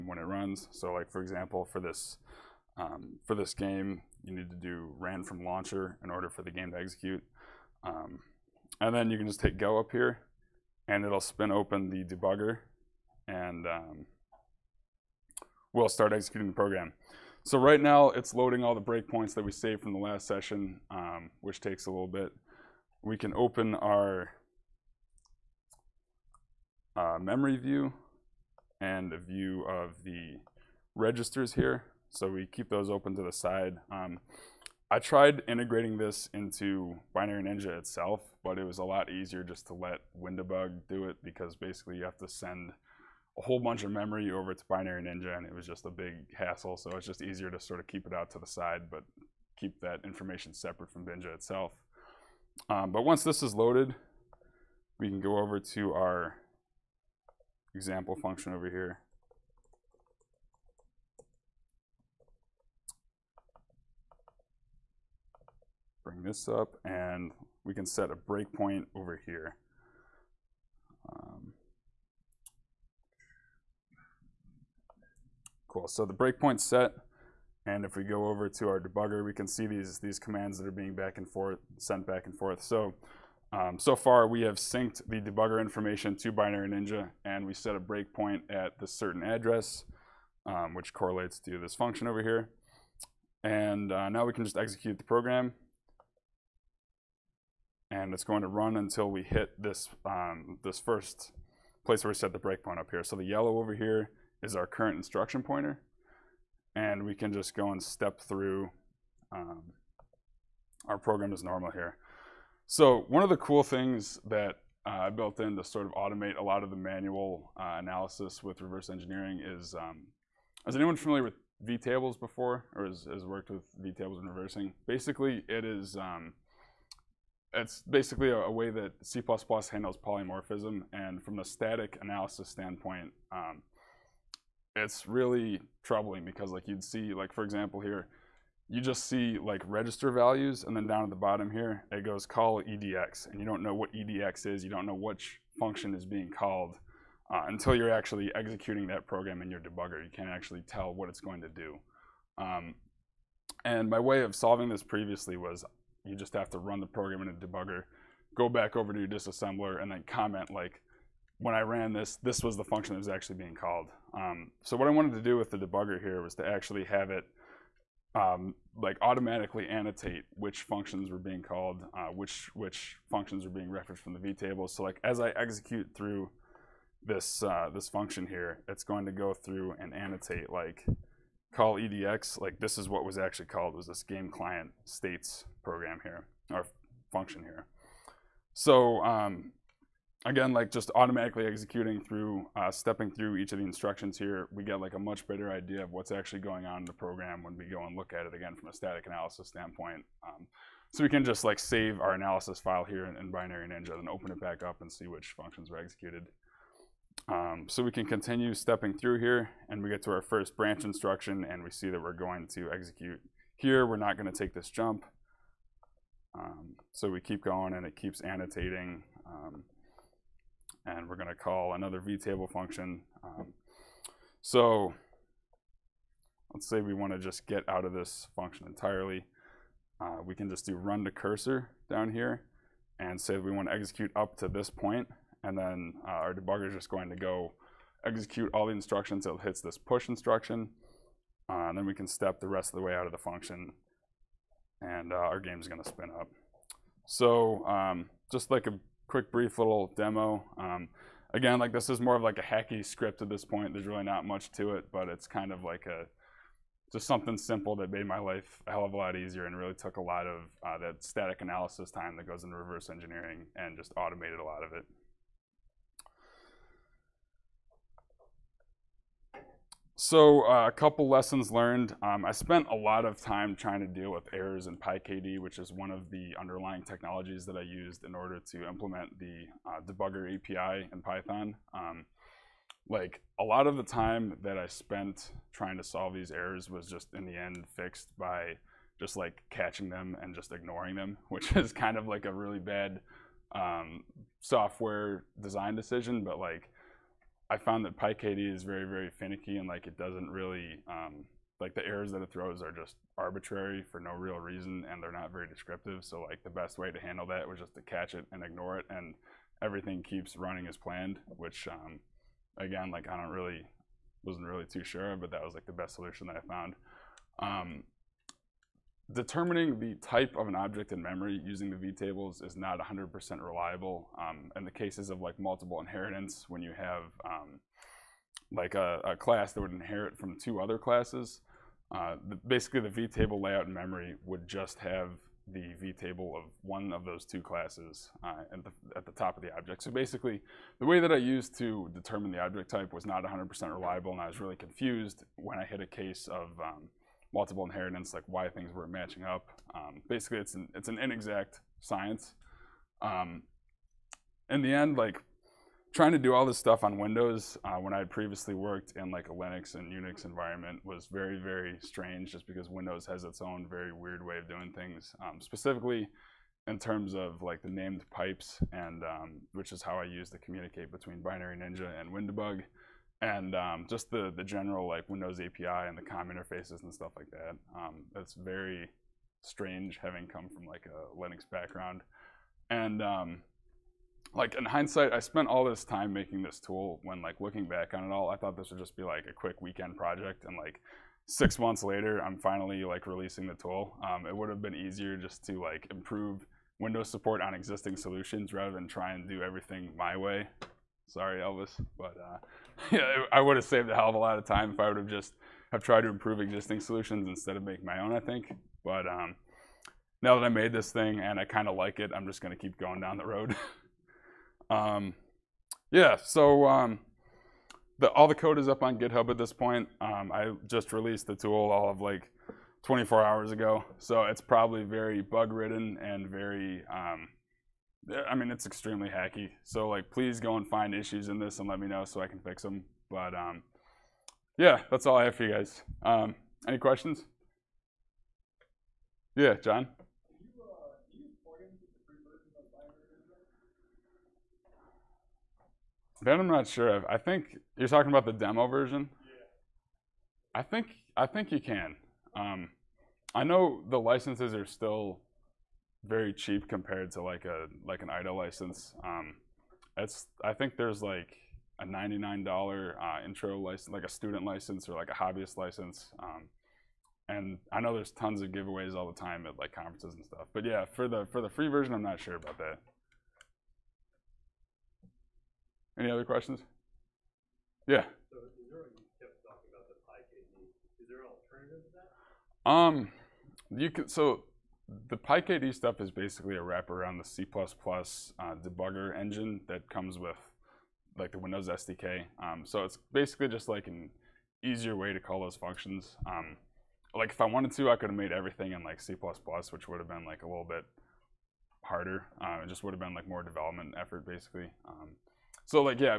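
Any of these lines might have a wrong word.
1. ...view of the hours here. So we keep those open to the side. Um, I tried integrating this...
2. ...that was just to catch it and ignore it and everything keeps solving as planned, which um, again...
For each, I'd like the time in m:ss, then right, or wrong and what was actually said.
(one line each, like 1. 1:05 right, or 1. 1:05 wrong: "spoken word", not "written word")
1. 0:29 wrong: "registers", not "hours"
2. 5:07 wrong: "running", not "solving".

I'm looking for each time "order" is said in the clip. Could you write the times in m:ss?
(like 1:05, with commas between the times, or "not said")
0:06, 4:38.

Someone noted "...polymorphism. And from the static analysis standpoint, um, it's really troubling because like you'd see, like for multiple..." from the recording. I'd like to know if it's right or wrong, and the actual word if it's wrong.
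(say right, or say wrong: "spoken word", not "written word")
wrong: "example", not "multiple".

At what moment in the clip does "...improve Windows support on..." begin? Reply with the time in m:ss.
6:35.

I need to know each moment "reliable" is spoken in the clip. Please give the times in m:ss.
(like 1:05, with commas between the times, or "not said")
5:23, 5:43.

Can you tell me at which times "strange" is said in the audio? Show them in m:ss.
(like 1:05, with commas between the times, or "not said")
6:01, 6:19.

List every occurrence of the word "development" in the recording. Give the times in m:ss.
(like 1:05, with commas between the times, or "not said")
8:23.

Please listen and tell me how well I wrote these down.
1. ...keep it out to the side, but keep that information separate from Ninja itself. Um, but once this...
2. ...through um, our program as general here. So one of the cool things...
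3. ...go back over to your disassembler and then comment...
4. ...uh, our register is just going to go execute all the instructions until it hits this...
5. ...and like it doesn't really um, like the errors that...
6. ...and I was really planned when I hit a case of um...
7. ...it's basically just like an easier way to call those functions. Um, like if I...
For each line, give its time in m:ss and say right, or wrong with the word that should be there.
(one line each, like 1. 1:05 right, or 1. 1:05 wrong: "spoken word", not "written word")
1. 0:47 right
2. 1:48 wrong: "normal", not "general"
3. 2:38 right
4. 3:56 wrong: "debugger", not "register"
5. 4:59 right
6. 5:44 wrong: "confused", not "planned"
7. 8:12 right.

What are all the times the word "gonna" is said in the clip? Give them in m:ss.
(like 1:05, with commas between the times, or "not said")
3:34, 6:52.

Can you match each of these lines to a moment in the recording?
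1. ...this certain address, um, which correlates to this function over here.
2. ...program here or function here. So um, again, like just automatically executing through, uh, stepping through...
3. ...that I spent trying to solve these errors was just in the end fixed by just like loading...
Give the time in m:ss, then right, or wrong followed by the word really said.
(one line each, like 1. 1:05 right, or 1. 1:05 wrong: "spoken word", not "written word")
1. 1:28 right
2. 3:05 right
3. 4:44 wrong: "catching", not "loading".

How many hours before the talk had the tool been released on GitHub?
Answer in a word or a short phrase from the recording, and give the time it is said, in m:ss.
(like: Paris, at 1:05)
24 hours, at 7:02.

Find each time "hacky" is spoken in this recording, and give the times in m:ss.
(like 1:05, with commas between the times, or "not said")
4:12, 7:09.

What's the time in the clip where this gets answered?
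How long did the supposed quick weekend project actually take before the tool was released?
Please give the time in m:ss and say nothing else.
6:31.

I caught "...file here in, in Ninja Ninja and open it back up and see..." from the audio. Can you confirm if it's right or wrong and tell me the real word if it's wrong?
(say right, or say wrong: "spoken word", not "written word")
wrong: "Binary", not "Ninja".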